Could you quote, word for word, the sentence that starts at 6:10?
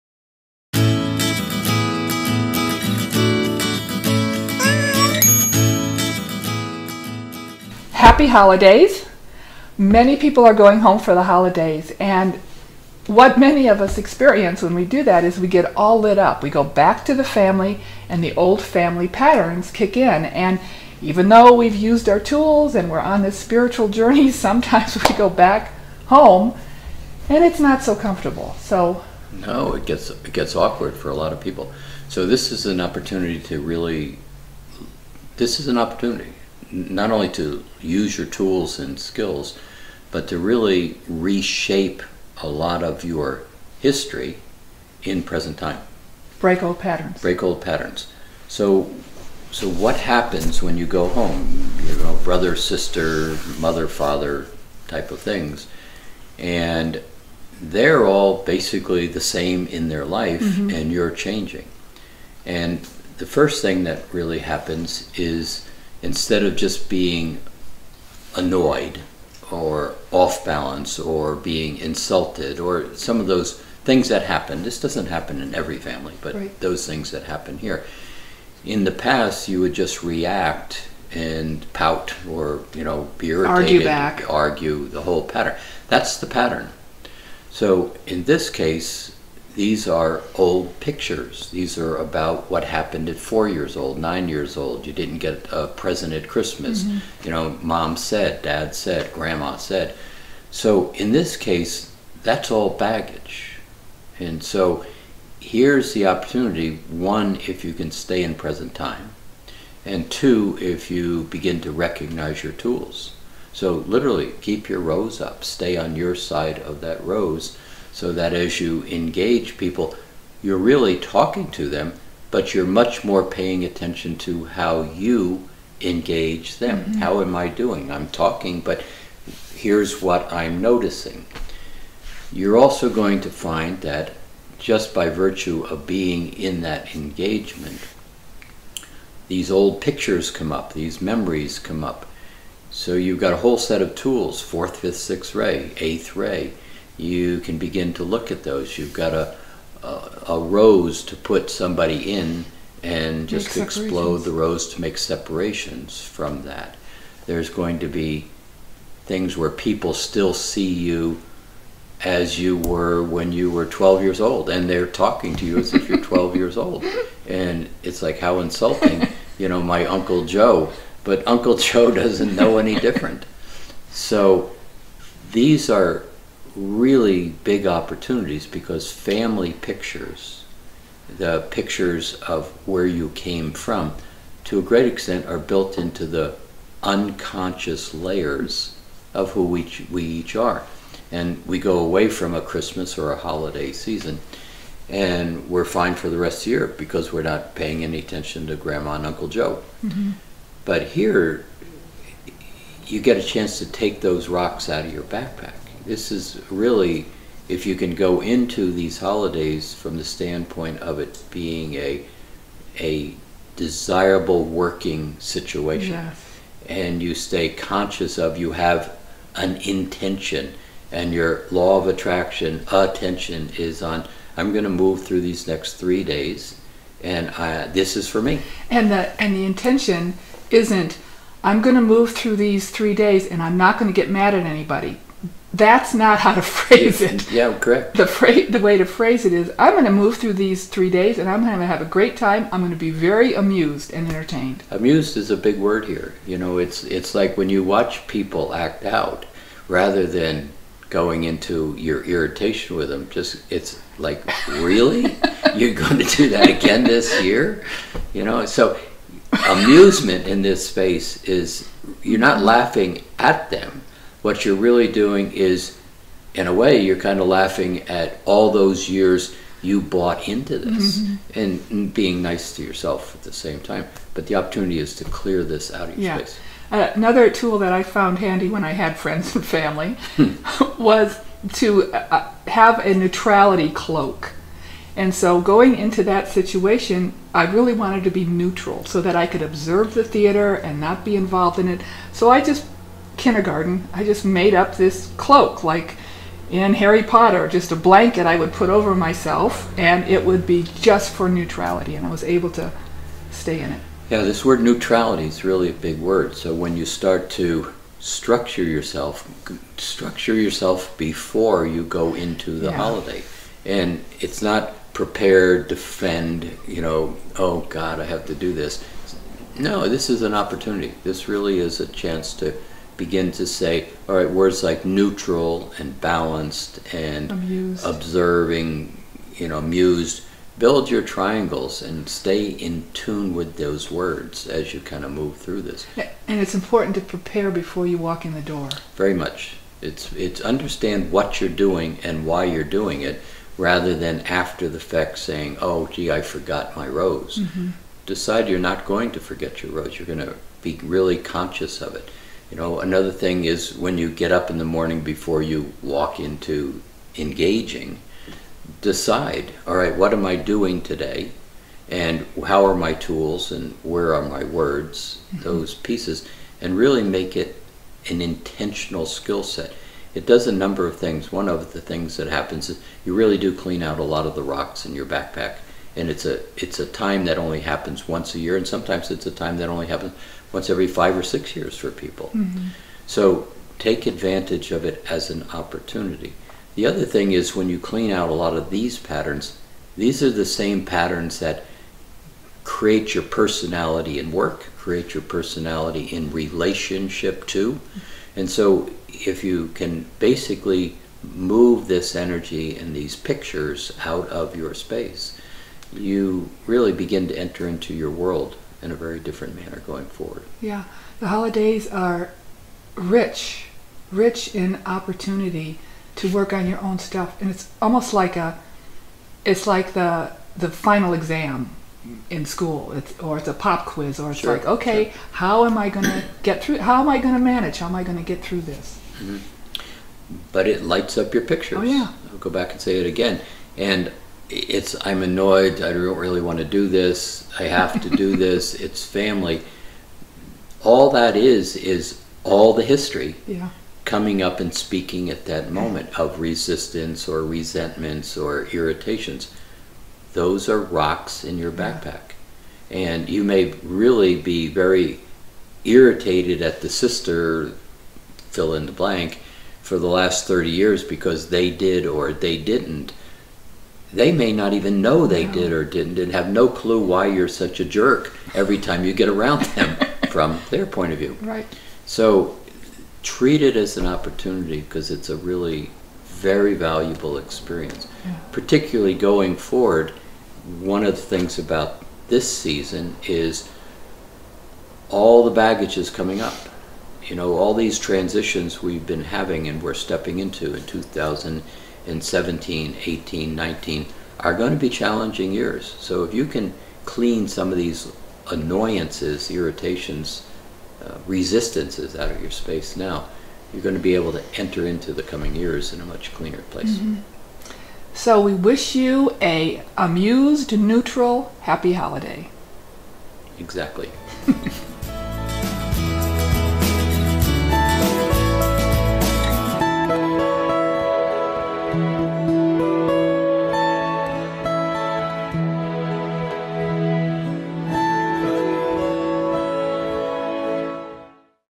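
It does a number of things.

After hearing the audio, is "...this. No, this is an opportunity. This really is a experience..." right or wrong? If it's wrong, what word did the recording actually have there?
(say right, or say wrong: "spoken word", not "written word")
wrong: "chance", not "experience".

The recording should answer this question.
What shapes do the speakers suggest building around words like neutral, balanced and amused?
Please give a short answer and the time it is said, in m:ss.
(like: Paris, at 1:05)
triangles, at 5:31.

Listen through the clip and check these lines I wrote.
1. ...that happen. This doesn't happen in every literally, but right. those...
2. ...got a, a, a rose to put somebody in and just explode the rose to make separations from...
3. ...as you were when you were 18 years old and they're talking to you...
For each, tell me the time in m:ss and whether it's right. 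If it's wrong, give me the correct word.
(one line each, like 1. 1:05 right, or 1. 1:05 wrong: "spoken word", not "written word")
1. 1:14 wrong: "family", not "literally"
2. 2:28 right
3. 2:42 wrong: "12", not "18".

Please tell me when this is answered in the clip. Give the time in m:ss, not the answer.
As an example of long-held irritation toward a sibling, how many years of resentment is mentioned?
7:40.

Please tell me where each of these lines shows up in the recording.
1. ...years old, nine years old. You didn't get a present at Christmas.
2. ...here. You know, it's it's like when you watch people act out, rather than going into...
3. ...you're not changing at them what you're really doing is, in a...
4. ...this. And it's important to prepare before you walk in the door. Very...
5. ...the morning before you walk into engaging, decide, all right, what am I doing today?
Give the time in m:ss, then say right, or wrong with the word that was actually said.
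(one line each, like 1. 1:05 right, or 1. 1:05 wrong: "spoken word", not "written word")
1. 1:33 right
2. 4:05 right
3. 4:22 wrong: "laughing", not "changing"
4. 5:35 right
5. 5:54 right.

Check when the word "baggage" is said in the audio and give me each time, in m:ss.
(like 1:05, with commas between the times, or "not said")
1:42, 8:05.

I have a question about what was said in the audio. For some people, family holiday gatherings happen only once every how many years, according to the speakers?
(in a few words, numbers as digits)
5 or 6 years.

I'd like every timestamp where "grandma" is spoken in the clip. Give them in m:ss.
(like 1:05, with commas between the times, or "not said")
1:39, 3:18.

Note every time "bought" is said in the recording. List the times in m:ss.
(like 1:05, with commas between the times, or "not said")
4:29.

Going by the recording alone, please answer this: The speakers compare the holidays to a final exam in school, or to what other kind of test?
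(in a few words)
pop quiz.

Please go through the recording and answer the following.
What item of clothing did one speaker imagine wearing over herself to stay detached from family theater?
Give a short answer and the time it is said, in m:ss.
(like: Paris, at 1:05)
neutrality cloak, at 4:42.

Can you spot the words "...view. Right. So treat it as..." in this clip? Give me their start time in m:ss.
7:51.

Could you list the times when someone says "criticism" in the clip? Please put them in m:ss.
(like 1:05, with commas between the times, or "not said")
not said.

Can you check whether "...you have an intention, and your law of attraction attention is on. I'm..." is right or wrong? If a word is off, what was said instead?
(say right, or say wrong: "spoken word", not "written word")
right.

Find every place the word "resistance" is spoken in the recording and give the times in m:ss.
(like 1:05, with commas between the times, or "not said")
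7:26, 8:21.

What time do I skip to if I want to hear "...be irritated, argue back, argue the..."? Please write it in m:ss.
1:23.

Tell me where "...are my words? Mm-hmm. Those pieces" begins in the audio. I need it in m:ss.
6:04.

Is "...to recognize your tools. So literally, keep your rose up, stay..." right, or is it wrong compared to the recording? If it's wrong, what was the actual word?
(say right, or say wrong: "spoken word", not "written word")
right.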